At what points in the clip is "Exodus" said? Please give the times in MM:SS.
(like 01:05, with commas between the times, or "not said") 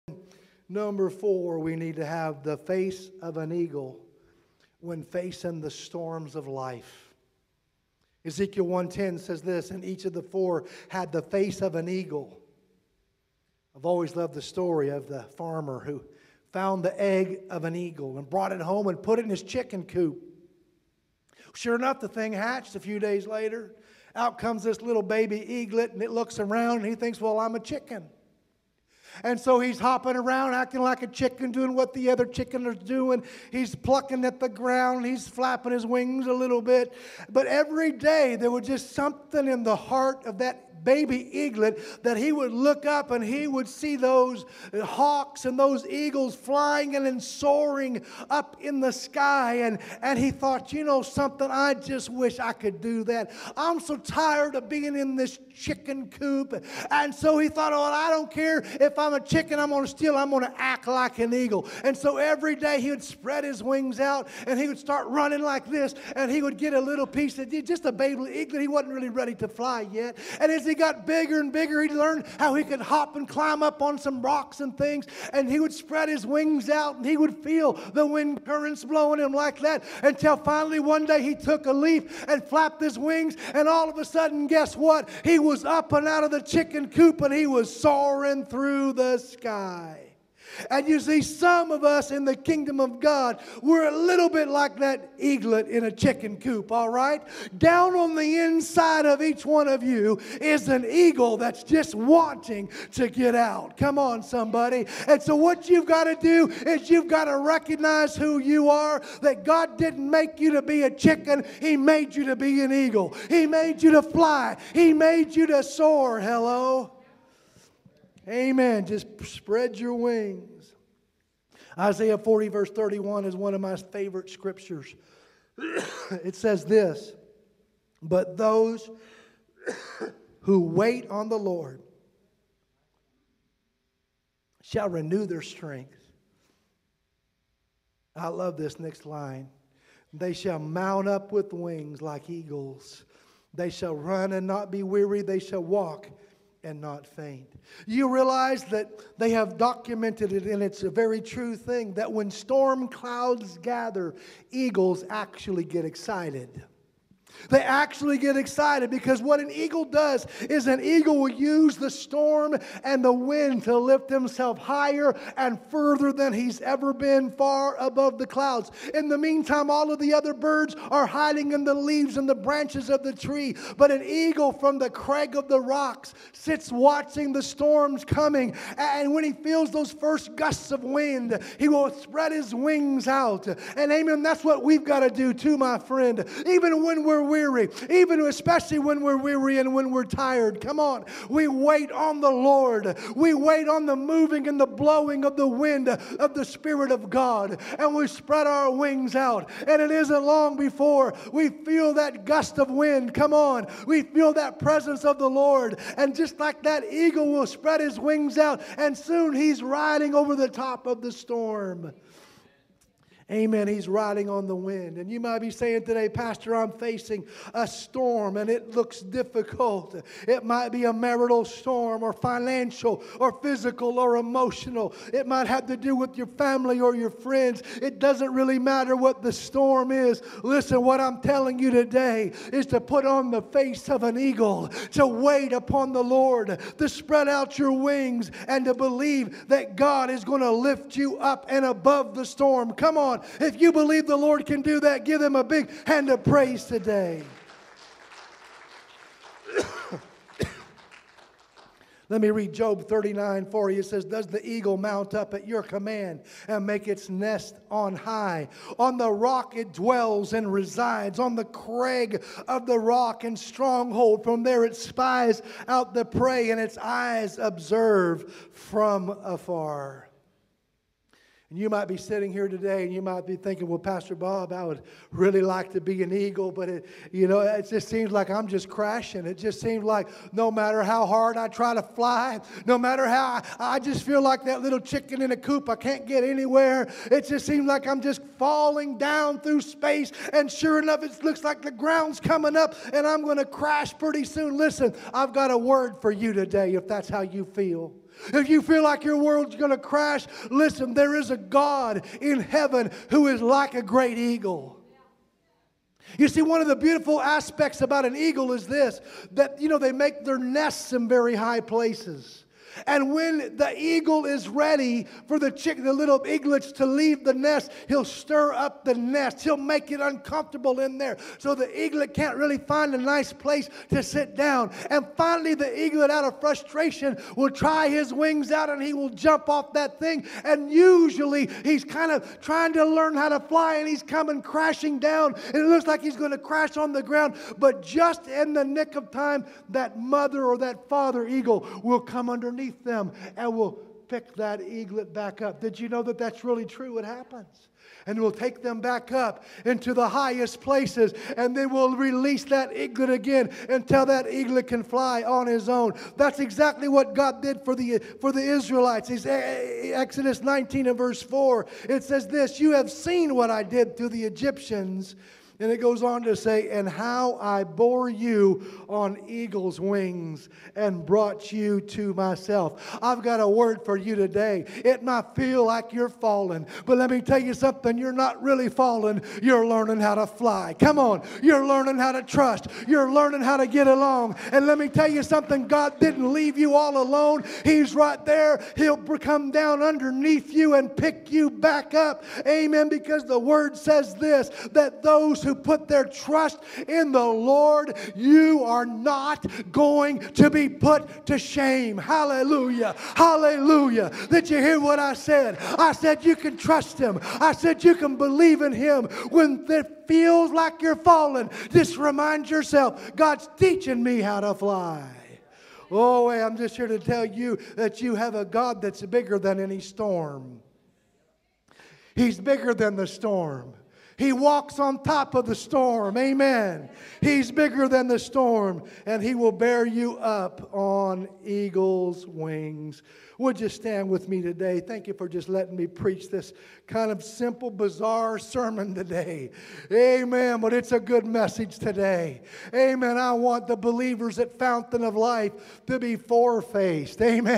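05:59.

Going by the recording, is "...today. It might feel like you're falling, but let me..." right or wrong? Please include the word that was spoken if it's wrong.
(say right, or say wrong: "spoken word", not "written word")
right.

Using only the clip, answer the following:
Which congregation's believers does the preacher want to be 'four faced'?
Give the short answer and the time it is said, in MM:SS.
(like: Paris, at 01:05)
Fountain of Life, at 07:24.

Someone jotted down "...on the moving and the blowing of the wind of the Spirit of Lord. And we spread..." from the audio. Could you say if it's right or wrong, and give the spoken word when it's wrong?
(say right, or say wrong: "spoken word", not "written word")
wrong: "God", not "Lord".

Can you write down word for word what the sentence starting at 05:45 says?
Did you know that that's really true?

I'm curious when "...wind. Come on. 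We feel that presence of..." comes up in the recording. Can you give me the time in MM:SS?
03:22.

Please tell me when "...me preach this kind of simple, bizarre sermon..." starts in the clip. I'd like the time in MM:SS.
07:15.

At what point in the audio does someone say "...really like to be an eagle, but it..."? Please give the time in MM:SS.
04:35.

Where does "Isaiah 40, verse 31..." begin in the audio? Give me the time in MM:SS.
02:01.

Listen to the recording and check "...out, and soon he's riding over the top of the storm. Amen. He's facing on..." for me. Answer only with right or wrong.
wrong.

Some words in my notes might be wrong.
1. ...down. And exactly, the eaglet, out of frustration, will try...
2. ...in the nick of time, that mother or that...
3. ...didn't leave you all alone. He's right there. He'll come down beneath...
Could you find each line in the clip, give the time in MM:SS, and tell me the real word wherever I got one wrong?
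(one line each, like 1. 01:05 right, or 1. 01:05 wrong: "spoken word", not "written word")
1. 05:24 wrong: "finally", not "exactly"
2. 05:38 right
3. 06:25 wrong: "underneath", not "beneath".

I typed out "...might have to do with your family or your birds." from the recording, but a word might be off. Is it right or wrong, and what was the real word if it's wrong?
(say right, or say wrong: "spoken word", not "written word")
wrong: "friends", not "birds".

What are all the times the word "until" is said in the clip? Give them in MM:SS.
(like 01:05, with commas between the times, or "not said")
01:20, 05:53.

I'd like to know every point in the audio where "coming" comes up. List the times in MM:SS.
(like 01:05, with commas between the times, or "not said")
02:58, 04:52, 05:34.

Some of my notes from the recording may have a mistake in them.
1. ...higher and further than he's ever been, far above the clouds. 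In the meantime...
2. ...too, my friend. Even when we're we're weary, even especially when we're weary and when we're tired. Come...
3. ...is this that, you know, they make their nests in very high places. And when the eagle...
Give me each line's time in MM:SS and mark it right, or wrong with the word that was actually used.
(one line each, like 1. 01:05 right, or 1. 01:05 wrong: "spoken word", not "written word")
1. 02:44 right
2. 03:05 right
3. 05:08 right.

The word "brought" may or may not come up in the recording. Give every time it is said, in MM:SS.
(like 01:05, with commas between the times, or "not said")
00:18, 06:11.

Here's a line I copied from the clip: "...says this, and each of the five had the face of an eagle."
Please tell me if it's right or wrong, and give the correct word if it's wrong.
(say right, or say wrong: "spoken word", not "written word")
wrong: "four", not "five".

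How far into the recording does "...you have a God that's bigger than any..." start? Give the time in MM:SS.
06:58.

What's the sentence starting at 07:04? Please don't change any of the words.
He walks on top of the storm.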